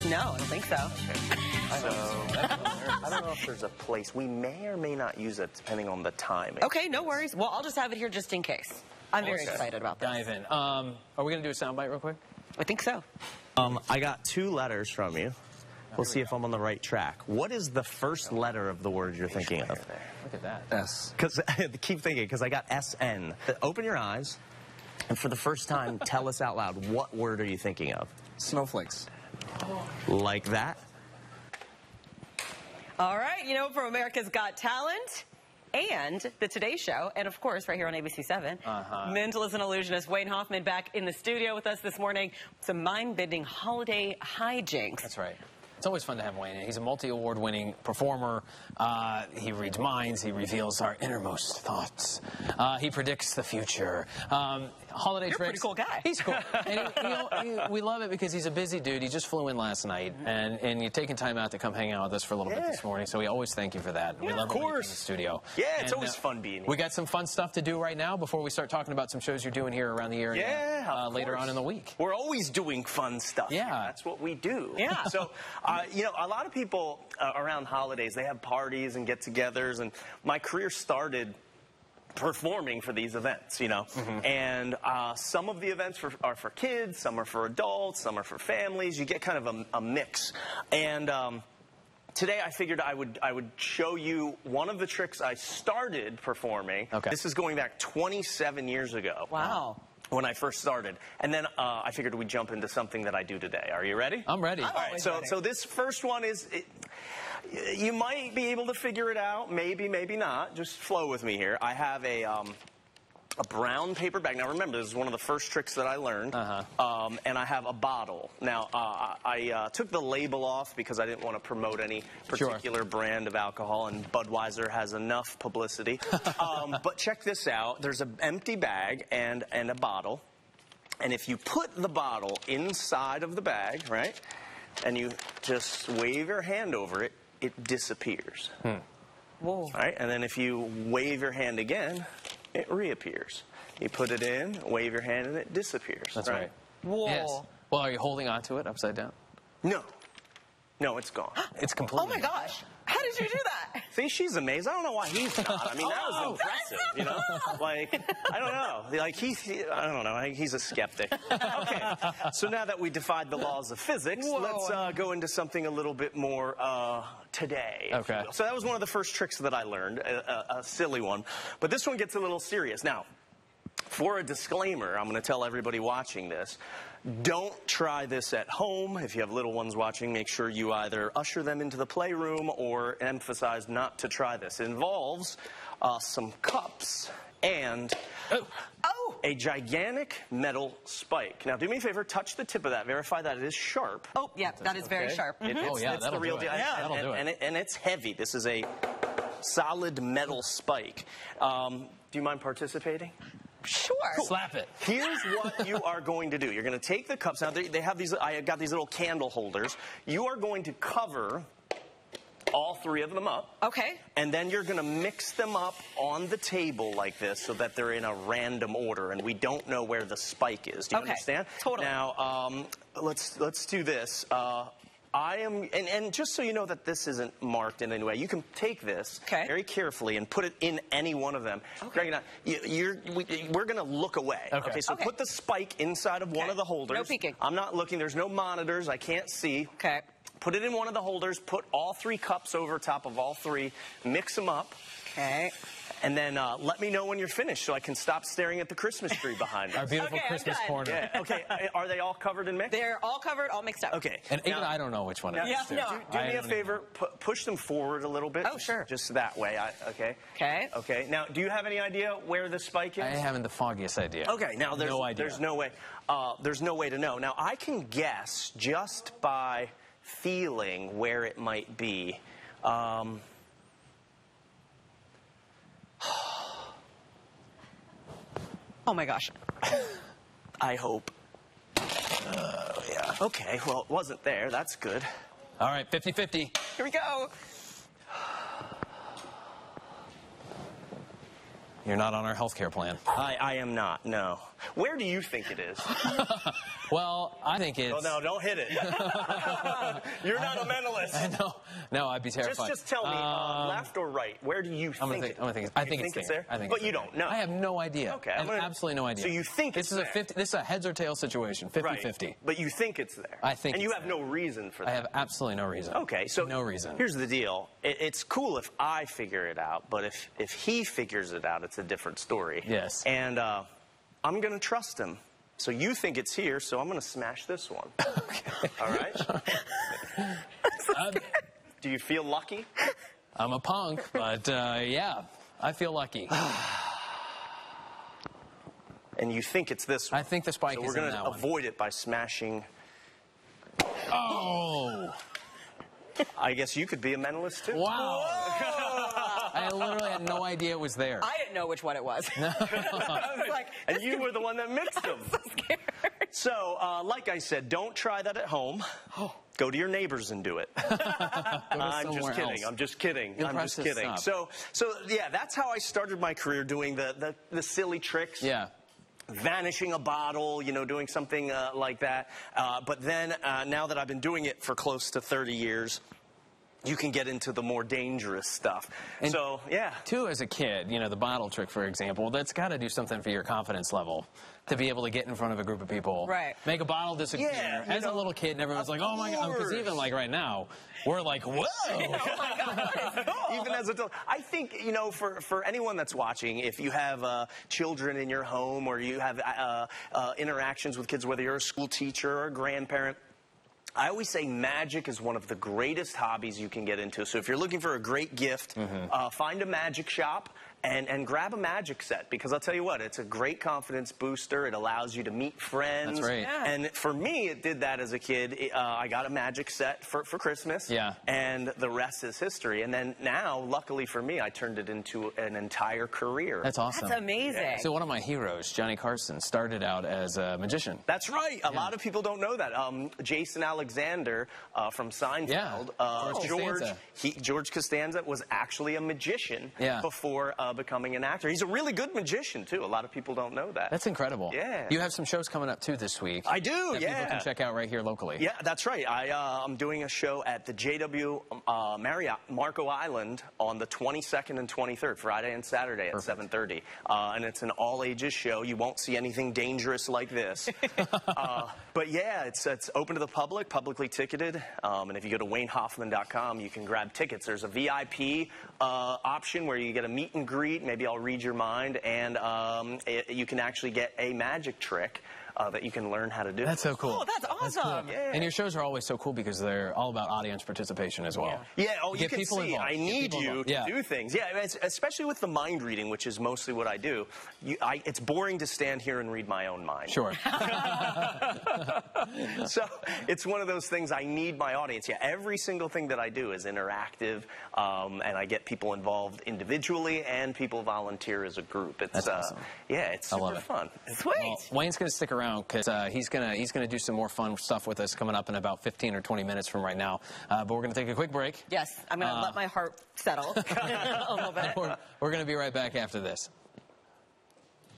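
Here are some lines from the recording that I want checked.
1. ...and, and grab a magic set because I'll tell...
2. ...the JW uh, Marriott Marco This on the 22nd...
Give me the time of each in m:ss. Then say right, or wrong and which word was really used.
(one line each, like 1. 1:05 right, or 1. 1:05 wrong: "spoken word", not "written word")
1. 6:50 right
2. 7:30 wrong: "Island", not "This".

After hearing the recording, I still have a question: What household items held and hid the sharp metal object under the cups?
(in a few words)
candle holders.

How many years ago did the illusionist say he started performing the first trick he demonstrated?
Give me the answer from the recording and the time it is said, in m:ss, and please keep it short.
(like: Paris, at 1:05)
27, at 1:37.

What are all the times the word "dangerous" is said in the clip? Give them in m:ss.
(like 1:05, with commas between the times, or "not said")
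6:17, 7:39.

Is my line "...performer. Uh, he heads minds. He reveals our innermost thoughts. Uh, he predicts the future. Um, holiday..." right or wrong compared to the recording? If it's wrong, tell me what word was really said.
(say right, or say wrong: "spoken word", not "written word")
wrong: "reads", not "heads".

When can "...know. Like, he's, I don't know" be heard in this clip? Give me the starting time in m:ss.
2:38.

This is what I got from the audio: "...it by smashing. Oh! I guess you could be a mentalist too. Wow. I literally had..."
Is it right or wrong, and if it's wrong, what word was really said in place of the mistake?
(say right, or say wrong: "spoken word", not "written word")
right.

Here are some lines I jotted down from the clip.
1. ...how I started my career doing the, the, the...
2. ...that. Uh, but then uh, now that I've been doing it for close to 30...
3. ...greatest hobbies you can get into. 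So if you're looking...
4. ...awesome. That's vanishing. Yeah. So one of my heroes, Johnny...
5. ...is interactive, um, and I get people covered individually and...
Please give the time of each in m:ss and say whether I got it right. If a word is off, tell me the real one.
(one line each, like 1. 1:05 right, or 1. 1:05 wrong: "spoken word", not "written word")
1. 6:05 right
2. 6:12 right
3. 6:45 right
4. 7:06 wrong: "amazing", not "vanishing"
5. 8:16 wrong: "involved", not "covered".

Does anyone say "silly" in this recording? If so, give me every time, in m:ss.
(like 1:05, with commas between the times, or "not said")
2:50, 6:07.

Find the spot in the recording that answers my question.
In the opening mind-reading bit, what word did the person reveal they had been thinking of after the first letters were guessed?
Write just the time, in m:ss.
0:28.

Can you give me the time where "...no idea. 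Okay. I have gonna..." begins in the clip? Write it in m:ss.
5:07.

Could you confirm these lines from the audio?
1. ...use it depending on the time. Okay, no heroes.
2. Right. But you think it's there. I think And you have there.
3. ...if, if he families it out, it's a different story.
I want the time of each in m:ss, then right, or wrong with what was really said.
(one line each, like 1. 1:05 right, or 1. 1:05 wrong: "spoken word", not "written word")
1. 0:05 wrong: "worries", not "heroes"
2. 5:11 right
3. 5:20 wrong: "figures", not "families".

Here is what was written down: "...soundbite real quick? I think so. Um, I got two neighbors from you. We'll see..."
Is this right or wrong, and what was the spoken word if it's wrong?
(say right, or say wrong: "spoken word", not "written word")
wrong: "letters", not "neighbors".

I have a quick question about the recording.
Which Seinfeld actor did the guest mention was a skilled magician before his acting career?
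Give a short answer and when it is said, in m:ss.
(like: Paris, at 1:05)
Jason Alexander, at 7:13.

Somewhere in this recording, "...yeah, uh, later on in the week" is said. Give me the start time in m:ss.
1:10.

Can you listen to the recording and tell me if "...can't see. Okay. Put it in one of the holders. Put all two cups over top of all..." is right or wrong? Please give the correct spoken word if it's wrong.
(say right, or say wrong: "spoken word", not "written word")
wrong: "three", not "two".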